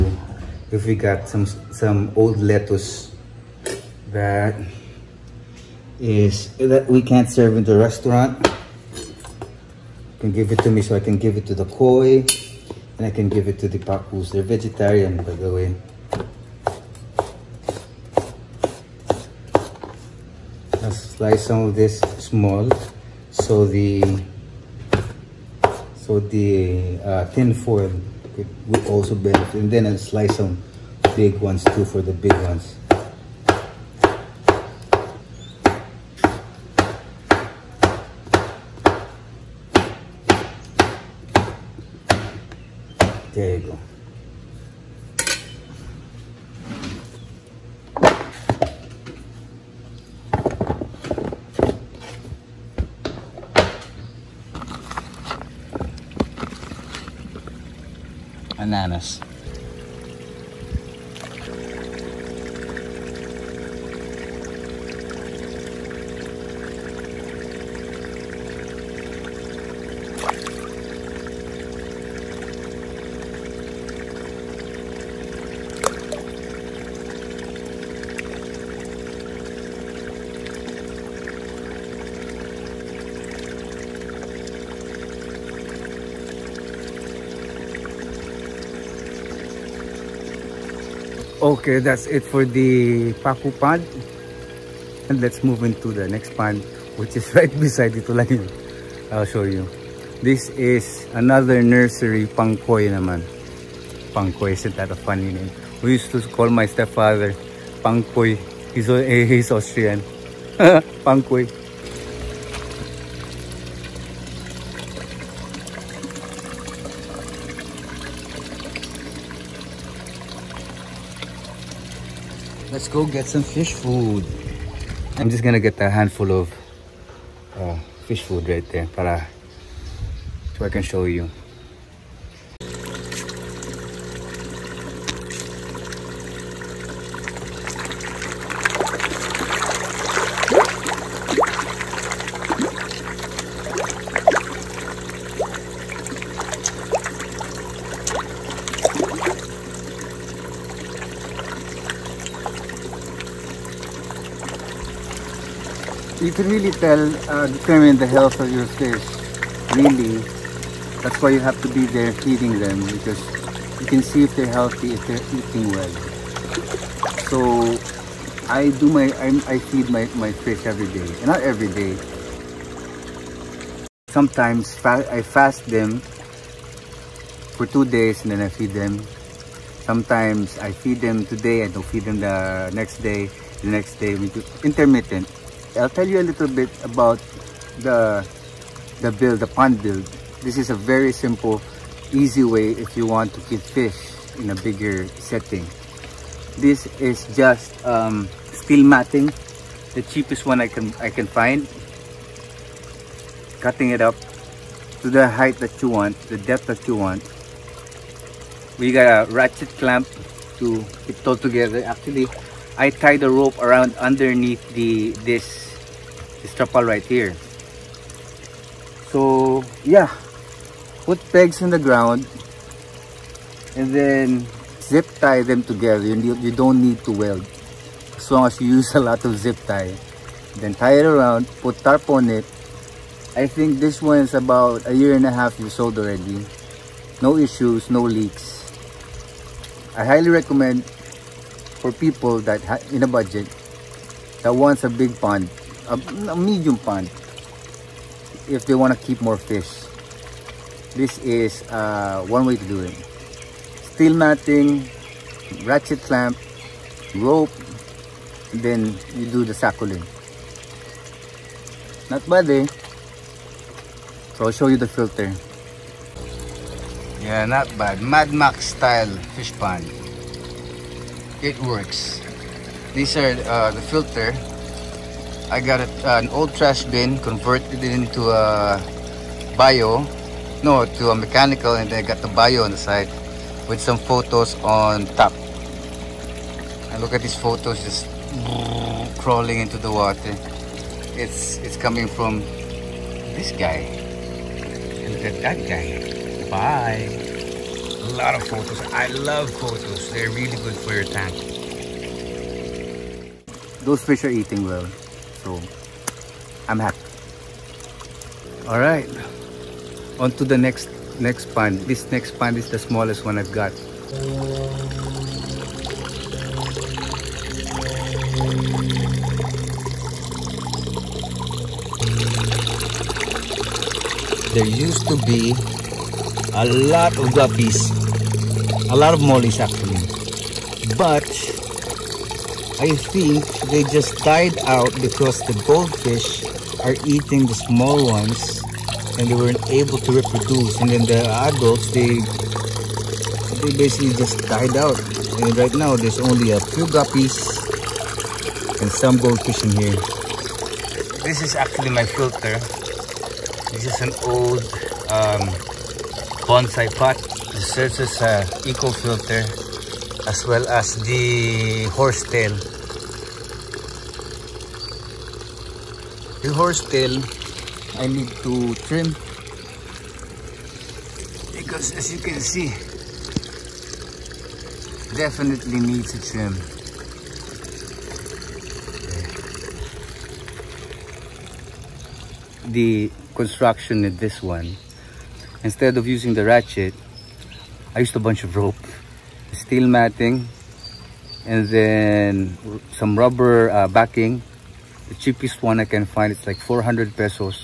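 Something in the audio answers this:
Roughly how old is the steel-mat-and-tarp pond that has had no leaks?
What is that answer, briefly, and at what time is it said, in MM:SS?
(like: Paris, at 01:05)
a year and a half, at 03:54.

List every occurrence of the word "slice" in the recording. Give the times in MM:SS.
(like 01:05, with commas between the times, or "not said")
00:21, 00:29.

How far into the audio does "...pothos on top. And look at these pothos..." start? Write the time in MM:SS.
04:43.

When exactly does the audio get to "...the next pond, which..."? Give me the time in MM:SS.
01:35.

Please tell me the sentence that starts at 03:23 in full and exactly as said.
Cutting it up to the height that you want, the depth that you want.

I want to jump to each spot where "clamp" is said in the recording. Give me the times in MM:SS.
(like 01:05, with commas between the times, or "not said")
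03:29, 04:16.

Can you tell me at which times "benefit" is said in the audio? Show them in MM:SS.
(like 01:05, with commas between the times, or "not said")
00:29.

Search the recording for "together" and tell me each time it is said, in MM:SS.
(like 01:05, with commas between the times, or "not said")
03:31, 03:45.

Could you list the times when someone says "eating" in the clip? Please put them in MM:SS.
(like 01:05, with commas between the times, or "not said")
02:45, 05:04, 05:37.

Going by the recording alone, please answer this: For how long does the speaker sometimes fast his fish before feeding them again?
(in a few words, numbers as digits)
2 days.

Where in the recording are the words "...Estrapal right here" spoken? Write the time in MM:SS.
03:36.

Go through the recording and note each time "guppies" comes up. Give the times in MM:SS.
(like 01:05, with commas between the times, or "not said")
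05:27, 05:46.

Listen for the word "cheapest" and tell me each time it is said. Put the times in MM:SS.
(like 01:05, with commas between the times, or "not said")
03:20, 06:35.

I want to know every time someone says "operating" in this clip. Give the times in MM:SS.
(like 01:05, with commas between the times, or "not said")
not said.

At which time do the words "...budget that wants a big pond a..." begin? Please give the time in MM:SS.
04:03.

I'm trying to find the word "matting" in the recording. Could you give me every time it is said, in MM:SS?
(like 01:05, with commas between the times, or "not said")
03:18, 04:14, 06:29.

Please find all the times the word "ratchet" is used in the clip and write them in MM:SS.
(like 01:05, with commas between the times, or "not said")
03:29, 04:15, 06:26.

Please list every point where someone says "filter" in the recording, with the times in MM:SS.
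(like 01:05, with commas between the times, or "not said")
04:24, 04:33, 05:52, 05:58.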